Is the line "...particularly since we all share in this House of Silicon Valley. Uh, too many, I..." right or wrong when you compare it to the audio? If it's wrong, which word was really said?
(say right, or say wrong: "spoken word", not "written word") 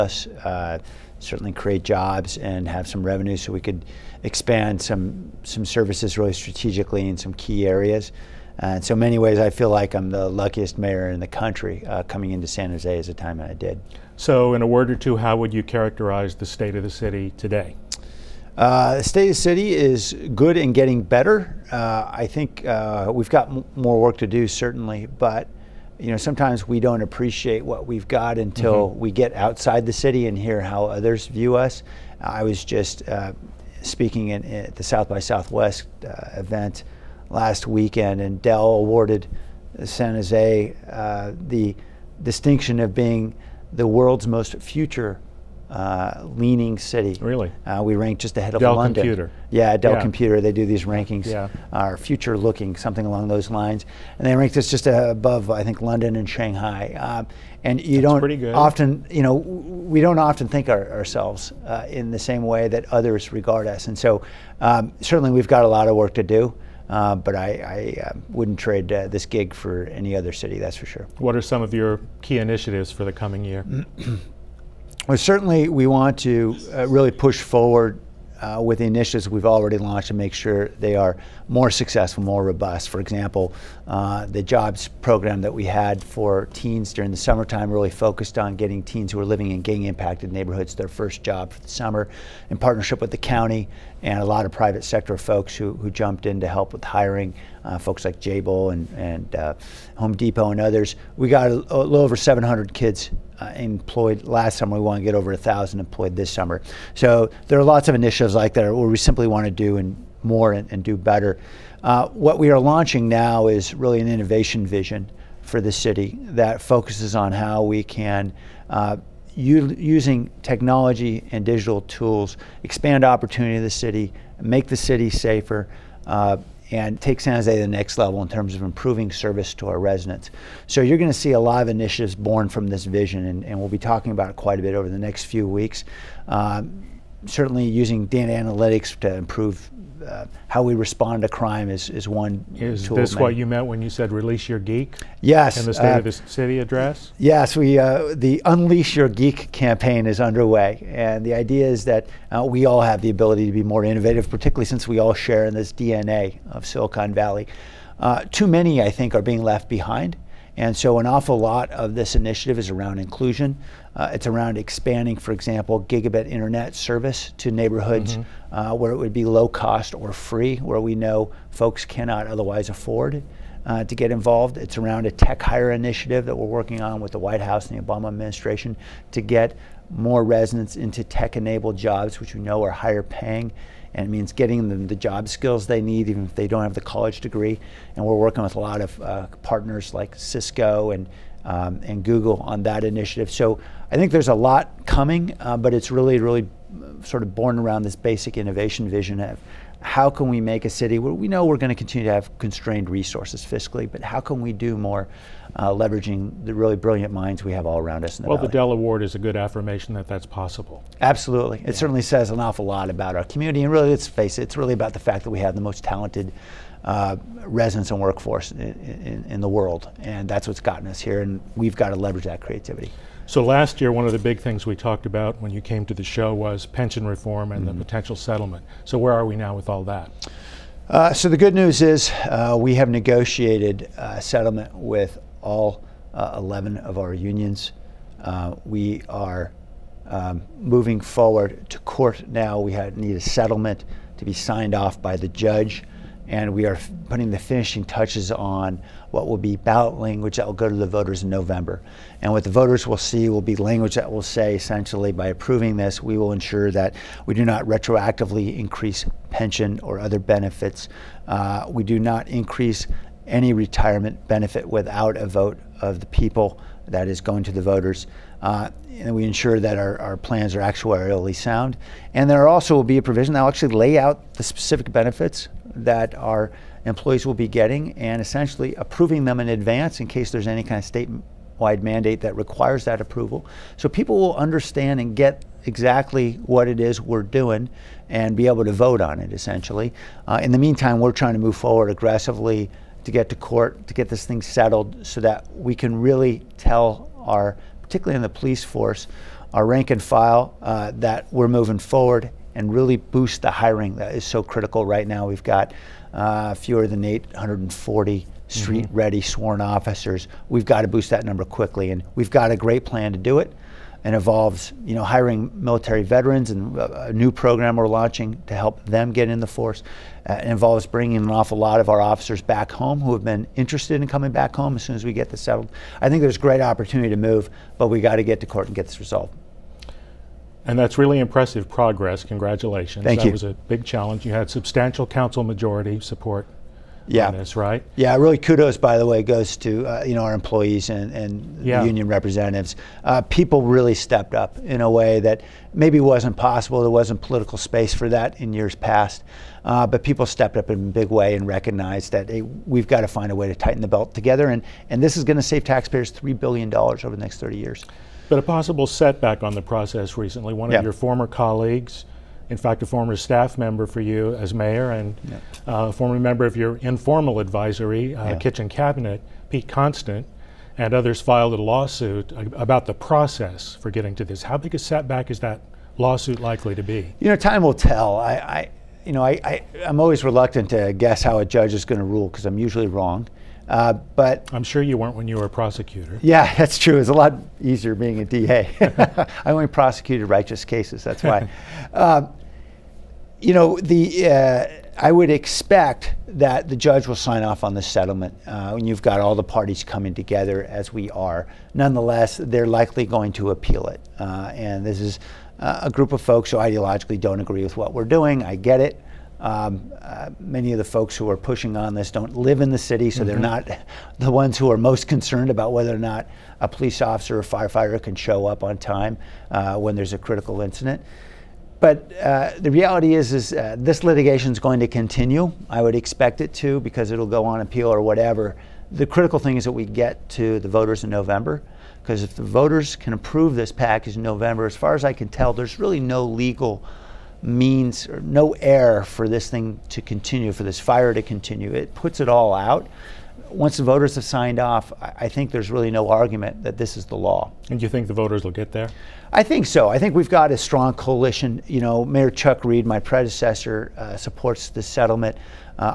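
wrong: "DNA", not "House".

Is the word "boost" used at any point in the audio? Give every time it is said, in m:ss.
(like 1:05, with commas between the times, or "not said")
5:02, 5:10.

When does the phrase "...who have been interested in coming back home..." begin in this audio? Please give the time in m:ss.
5:22.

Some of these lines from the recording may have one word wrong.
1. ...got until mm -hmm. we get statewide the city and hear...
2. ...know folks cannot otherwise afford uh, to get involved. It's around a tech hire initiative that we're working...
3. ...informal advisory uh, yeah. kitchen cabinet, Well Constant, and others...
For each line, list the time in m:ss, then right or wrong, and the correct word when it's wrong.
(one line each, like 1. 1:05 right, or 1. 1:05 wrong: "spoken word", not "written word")
1. 0:28 wrong: "outside", not "statewide"
2. 2:50 right
3. 6:06 wrong: "Pete", not "Well".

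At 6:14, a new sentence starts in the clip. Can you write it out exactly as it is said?
How big a setback is that lawsuit likely to be?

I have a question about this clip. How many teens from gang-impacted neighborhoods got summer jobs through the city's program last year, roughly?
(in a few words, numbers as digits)
700.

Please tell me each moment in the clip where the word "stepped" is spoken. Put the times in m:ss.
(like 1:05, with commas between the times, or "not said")
5:43, 5:50.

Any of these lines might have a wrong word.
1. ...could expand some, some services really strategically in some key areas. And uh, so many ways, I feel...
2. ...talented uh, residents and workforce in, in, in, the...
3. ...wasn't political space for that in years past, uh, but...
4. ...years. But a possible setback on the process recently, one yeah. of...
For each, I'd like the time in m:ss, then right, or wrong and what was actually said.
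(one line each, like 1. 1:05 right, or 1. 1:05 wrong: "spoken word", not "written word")
1. 0:03 right
2. 3:35 right
3. 5:46 right
4. 5:57 right.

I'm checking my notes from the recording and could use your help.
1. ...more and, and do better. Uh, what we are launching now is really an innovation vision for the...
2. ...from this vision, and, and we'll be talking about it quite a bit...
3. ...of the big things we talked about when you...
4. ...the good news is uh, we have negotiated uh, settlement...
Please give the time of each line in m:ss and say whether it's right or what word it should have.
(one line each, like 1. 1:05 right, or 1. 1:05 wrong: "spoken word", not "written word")
1. 1:50 right
2. 2:12 right
3. 3:44 right
4. 3:51 right.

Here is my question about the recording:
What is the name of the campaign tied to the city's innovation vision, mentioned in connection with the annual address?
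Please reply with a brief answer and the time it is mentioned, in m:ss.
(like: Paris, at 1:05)
Unleash Your Geek, at 2:28.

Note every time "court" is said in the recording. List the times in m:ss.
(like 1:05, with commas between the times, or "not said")
4:01, 4:53, 5:28.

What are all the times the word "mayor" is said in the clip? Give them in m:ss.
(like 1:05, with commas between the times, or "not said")
0:10, 6:04, 7:32.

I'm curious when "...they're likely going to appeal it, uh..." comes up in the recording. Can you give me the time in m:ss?
6:42.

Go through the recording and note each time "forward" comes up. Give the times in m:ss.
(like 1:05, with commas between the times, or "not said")
1:17, 4:01, 4:51, 5:01.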